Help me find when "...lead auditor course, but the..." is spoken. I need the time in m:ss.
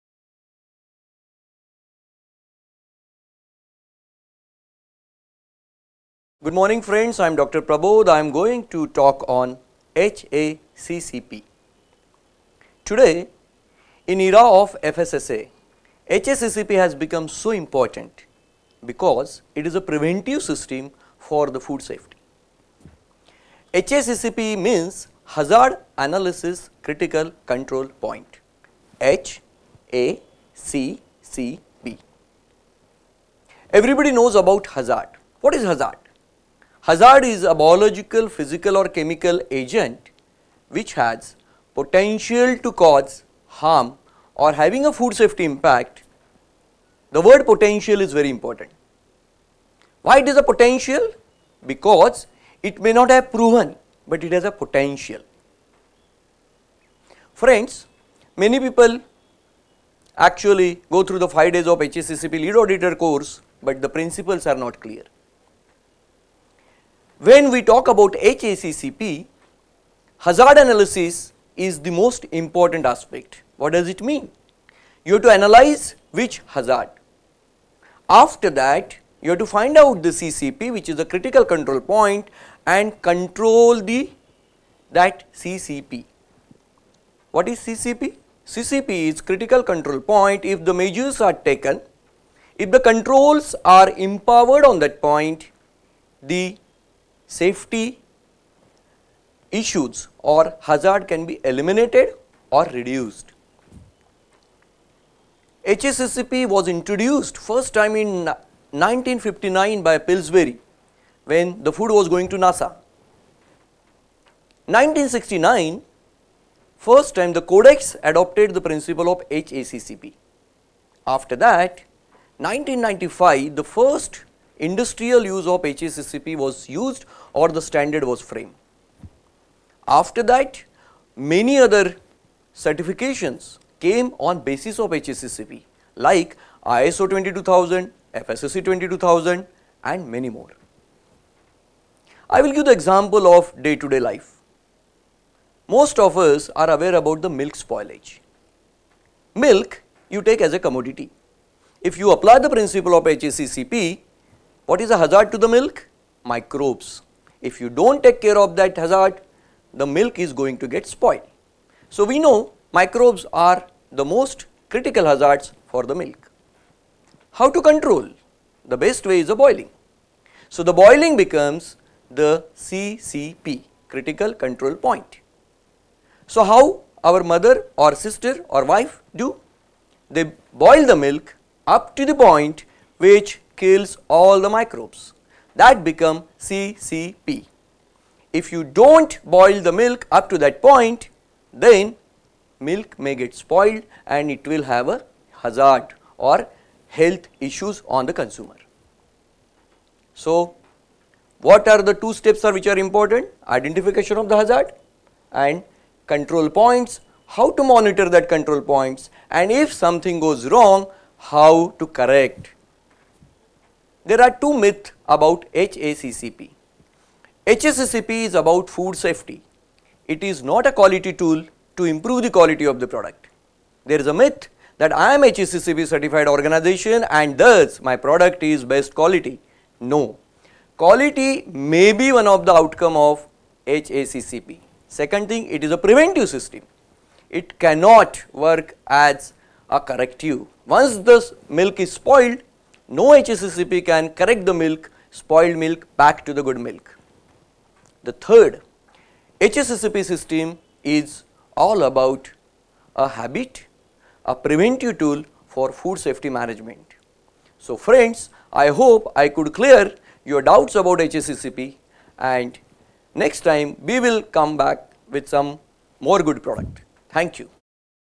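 1:02.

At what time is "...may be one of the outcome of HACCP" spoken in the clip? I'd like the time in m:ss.
3:51.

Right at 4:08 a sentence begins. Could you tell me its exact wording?
The third HACCP system is all about a habit, a preventive tool for food safety management.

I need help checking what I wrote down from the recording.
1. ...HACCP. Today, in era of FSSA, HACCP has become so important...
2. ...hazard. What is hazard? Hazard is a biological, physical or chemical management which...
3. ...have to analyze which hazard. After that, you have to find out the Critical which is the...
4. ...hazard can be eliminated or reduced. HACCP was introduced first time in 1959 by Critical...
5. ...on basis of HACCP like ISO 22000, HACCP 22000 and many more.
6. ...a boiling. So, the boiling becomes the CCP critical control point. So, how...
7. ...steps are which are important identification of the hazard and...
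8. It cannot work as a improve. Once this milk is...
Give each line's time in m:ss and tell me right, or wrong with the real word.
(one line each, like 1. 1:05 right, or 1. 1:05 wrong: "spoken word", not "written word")
1. 0:09 right
2. 0:34 wrong: "agent", not "management"
3. 1:15 wrong: "CCP", not "Critical"
4. 1:40 wrong: "Pillsbury", not "Critical"
5. 2:14 wrong: "FSSC", not "HACCP"
6. 2:49 right
7. 3:22 right
8. 3:57 wrong: "corrective", not "improve".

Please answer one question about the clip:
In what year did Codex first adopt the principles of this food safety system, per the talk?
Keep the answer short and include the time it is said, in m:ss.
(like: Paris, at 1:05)
1969, at 1:54.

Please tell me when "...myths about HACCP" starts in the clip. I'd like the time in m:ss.
3:34.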